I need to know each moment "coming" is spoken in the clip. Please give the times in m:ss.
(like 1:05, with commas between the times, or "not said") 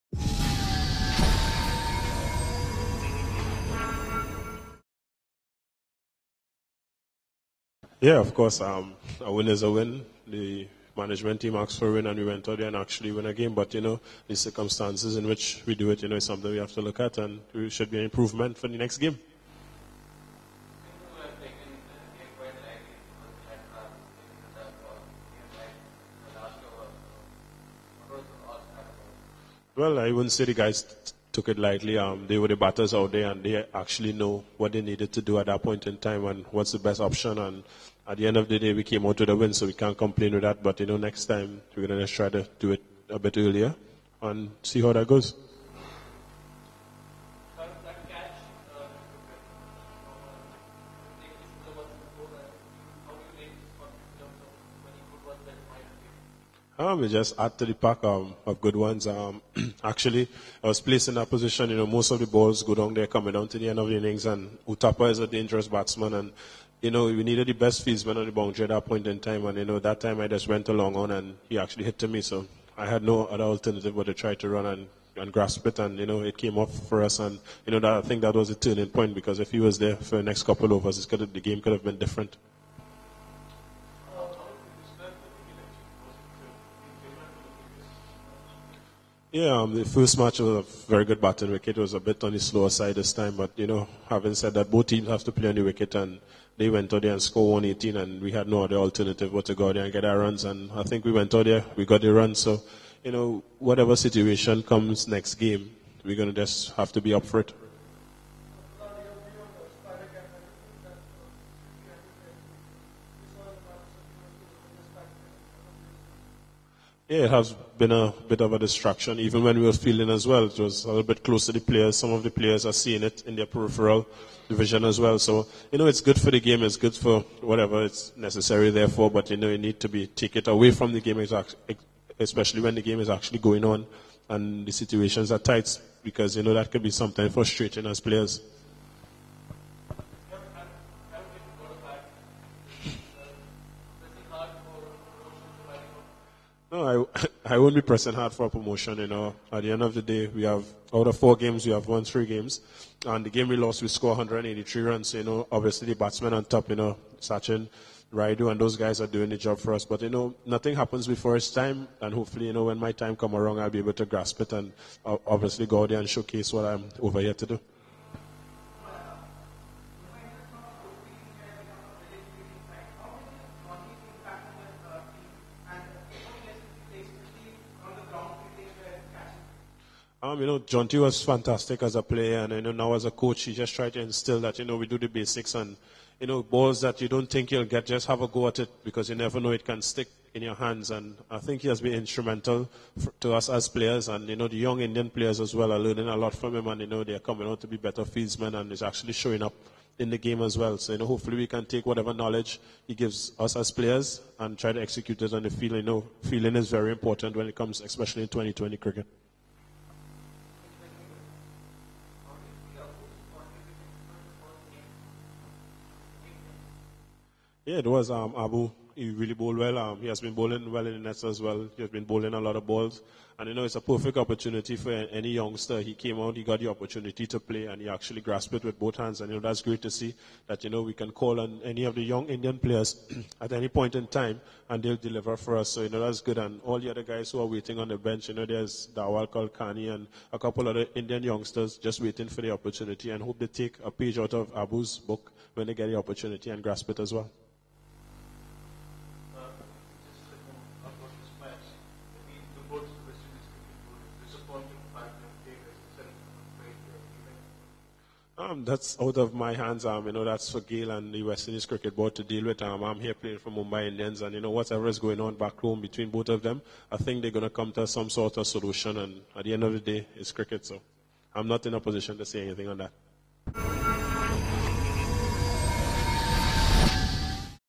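1:03, 3:17.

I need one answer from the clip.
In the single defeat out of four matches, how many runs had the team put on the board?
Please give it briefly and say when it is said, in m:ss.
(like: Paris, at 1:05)
183, at 2:34.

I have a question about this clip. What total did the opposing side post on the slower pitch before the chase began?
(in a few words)
118.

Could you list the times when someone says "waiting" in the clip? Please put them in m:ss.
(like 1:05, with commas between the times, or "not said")
3:57, 4:02.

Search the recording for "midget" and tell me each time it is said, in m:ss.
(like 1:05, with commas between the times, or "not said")
not said.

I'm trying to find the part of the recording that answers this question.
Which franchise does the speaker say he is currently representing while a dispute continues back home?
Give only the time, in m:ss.
4:23.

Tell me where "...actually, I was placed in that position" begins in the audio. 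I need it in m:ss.
0:59.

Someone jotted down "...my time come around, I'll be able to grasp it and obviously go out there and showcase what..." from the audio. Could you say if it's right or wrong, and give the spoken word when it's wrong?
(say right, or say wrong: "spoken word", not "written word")
right.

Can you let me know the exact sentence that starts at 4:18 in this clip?
um, that's out of my hands.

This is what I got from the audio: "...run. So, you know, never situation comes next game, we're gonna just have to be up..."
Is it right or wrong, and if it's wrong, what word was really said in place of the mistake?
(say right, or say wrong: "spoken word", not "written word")
wrong: "whatever", not "never".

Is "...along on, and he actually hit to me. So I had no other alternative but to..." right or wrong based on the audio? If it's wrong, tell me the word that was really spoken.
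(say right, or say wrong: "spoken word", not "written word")
right.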